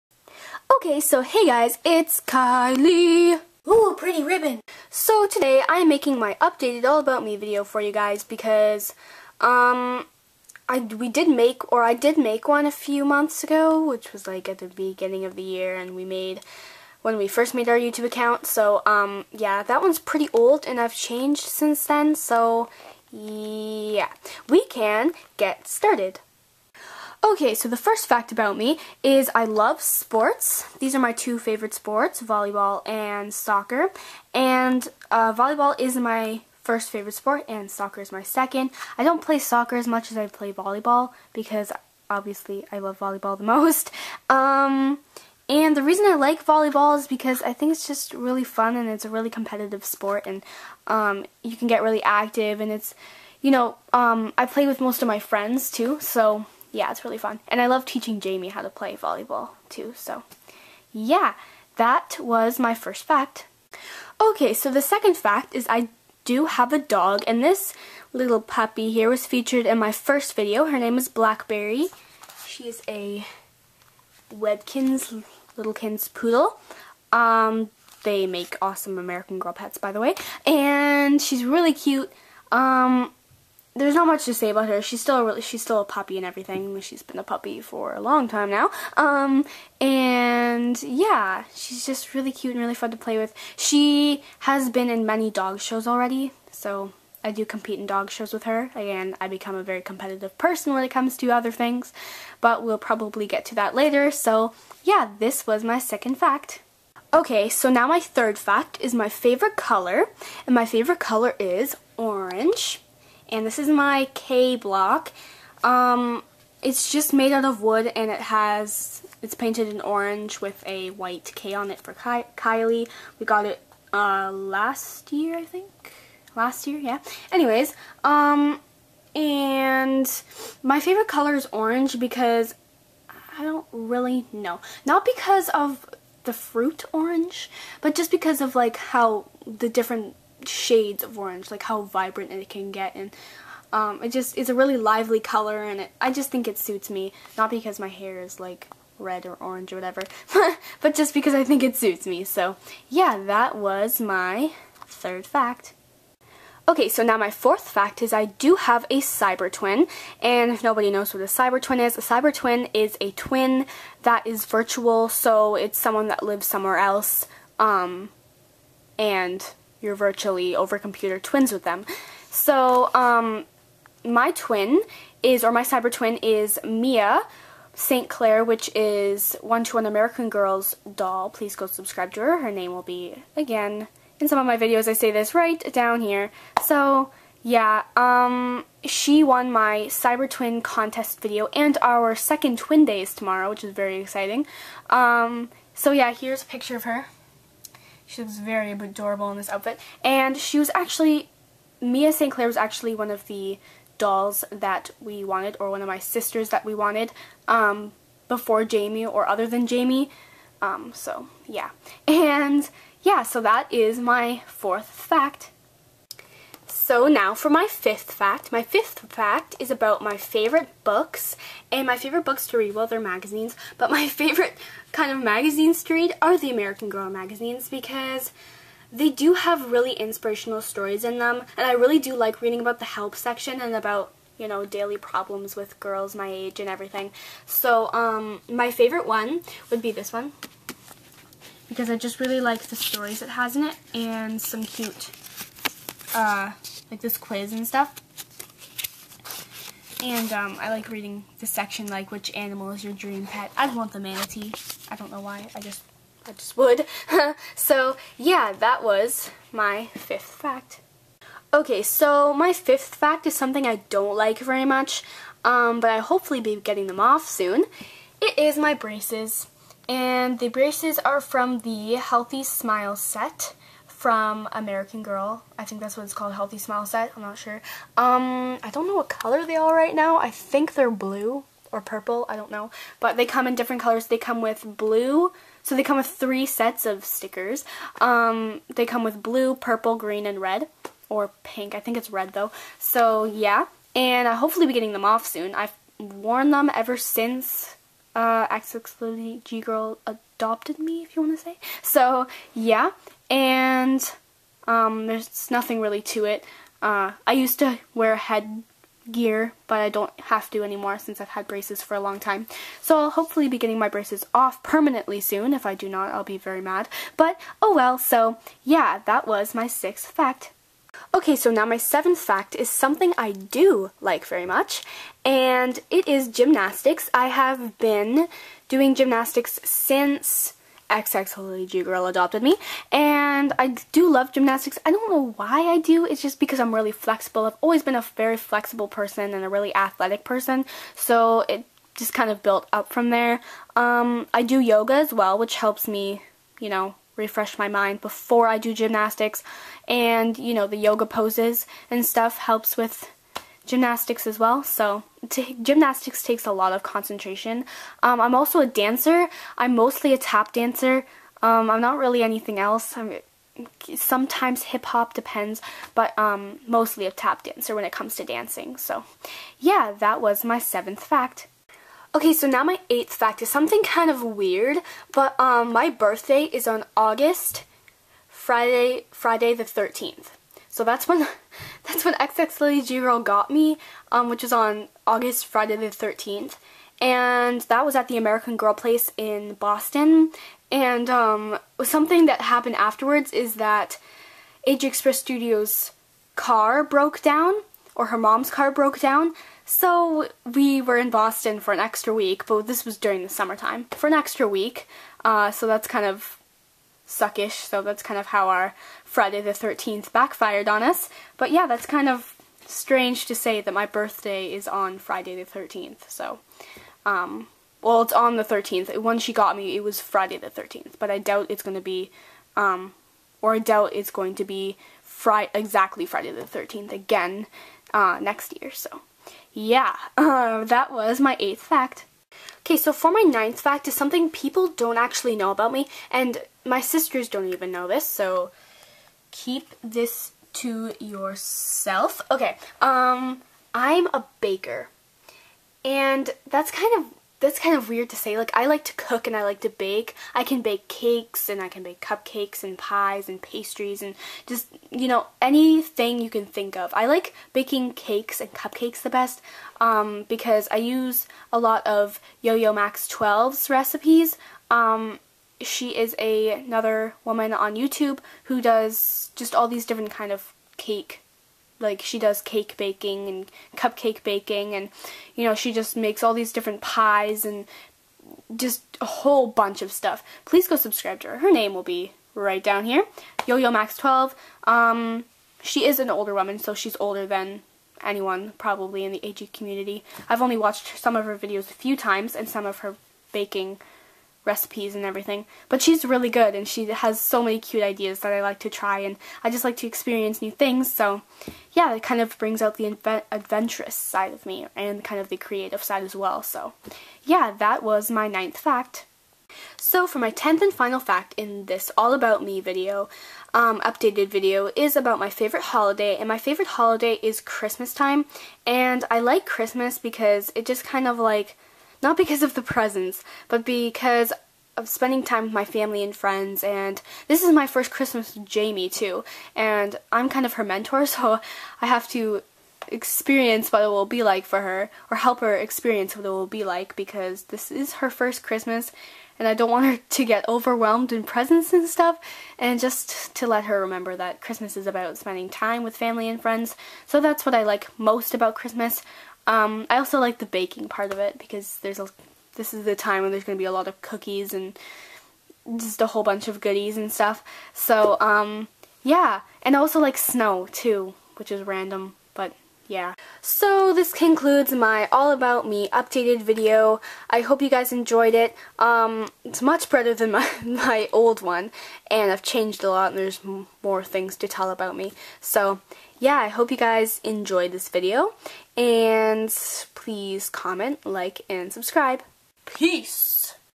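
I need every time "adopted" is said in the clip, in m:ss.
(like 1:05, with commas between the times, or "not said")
5:00, 5:32.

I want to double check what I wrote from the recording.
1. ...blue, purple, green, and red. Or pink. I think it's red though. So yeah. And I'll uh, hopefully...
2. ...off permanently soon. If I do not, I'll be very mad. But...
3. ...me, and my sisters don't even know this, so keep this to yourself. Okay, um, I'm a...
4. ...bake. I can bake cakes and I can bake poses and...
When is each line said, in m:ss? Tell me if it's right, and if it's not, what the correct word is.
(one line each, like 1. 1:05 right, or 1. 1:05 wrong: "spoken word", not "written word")
1. 4:49 right
2. 5:14 right
3. 7:15 right
4. 7:29 wrong: "cupcakes", not "poses".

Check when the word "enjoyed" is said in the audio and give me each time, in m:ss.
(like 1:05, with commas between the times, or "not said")
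9:27, 9:37.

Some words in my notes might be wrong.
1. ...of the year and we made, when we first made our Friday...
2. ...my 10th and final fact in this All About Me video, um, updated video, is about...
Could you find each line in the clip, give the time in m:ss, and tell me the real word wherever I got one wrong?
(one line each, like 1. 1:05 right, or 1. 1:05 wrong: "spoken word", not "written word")
1. 0:15 wrong: "YouTube", not "Friday"
2. 8:30 right.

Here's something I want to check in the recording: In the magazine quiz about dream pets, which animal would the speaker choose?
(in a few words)
Manatee.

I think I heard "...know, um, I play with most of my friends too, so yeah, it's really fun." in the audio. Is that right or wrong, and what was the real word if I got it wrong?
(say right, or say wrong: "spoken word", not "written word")
right.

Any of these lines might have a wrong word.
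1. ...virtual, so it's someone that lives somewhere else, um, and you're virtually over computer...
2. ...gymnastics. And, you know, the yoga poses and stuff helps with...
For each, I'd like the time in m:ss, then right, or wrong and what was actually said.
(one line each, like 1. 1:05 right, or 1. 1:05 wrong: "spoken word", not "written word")
1. 2:44 right
2. 5:48 right.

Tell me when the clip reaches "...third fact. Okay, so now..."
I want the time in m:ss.
2:34.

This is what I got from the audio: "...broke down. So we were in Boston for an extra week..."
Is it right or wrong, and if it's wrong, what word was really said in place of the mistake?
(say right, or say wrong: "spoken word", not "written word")
right.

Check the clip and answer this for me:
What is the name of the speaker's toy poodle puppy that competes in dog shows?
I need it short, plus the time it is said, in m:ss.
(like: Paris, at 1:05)
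Blackberry, at 1:11.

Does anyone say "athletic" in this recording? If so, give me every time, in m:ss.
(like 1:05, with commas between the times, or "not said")
5:39.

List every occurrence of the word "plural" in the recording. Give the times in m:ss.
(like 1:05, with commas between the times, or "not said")
not said.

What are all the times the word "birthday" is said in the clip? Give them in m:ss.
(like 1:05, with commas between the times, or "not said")
6:15, 6:53.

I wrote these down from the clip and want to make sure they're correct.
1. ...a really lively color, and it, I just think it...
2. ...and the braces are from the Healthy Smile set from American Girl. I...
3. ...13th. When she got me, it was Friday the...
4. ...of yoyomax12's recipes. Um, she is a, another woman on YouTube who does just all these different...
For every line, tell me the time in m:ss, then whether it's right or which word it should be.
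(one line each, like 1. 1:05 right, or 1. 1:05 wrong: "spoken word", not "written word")
1. 2:24 right
2. 4:29 right
3. 6:58 right
4. 7:41 right.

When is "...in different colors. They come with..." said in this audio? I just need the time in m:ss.
4:43.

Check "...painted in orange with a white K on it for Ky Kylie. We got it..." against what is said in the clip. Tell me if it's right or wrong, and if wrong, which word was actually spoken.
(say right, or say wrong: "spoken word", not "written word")
right.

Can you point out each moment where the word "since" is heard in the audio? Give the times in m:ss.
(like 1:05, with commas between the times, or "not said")
0:21, 4:56, 5:10, 5:29.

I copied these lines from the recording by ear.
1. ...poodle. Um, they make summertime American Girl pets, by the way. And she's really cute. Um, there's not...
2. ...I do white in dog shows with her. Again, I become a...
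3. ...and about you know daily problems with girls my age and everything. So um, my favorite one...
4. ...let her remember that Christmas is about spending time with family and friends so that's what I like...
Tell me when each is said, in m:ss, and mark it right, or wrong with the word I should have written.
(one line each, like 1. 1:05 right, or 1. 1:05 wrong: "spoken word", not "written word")
1. 1:16 wrong: "awesome", not "summertime"
2. 1:37 wrong: "compete", not "white"
3. 3:53 right
4. 9:03 right.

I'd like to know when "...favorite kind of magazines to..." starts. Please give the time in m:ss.
3:44.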